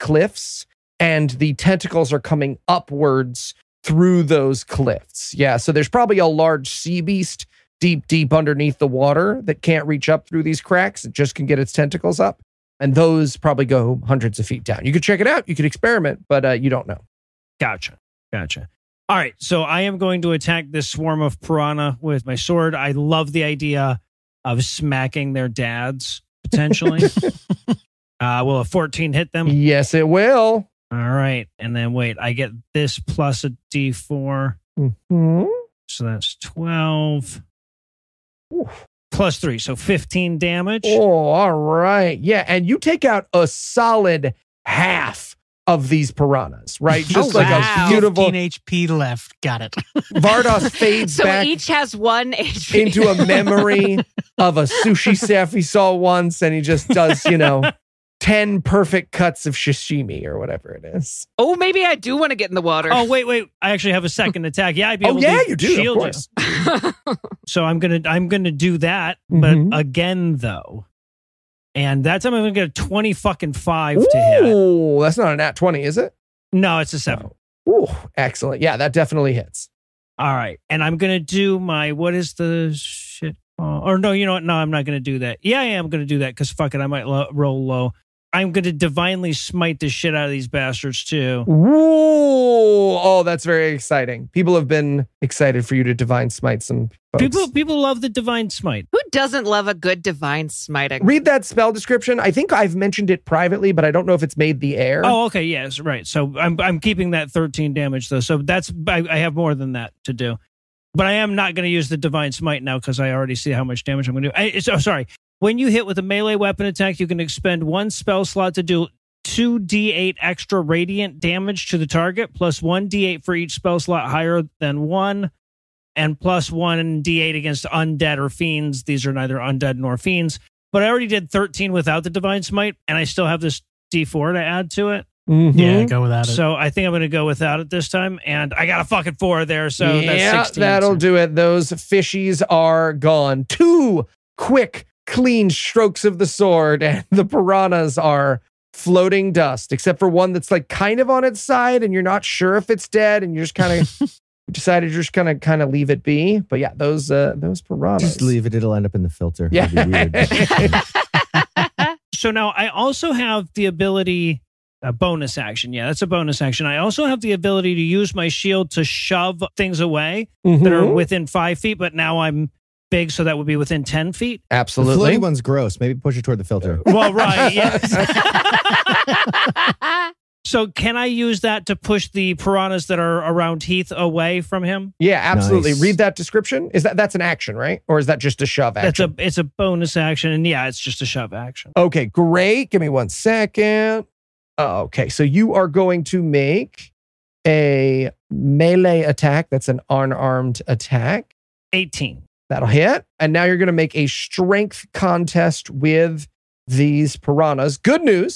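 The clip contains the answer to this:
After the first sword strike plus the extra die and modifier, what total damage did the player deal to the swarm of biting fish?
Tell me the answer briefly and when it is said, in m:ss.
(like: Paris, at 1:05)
15, at 0:39.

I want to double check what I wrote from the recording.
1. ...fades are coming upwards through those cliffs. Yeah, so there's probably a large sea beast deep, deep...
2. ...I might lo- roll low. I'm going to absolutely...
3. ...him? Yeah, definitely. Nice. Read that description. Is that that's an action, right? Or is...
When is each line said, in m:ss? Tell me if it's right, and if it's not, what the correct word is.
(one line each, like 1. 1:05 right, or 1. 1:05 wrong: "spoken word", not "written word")
1. 0:01 wrong: "tentacles", not "fades"
2. 1:26 wrong: "divinely", not "absolutely"
3. 3:04 wrong: "absolutely", not "definitely".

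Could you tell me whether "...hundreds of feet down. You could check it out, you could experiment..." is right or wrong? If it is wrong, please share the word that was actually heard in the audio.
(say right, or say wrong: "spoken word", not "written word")
right.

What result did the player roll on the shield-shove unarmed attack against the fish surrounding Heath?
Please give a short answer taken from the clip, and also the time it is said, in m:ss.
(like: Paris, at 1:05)
18, at 3:21.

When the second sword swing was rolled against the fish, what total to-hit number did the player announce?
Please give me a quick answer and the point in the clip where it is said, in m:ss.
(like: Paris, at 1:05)
25, at 1:12.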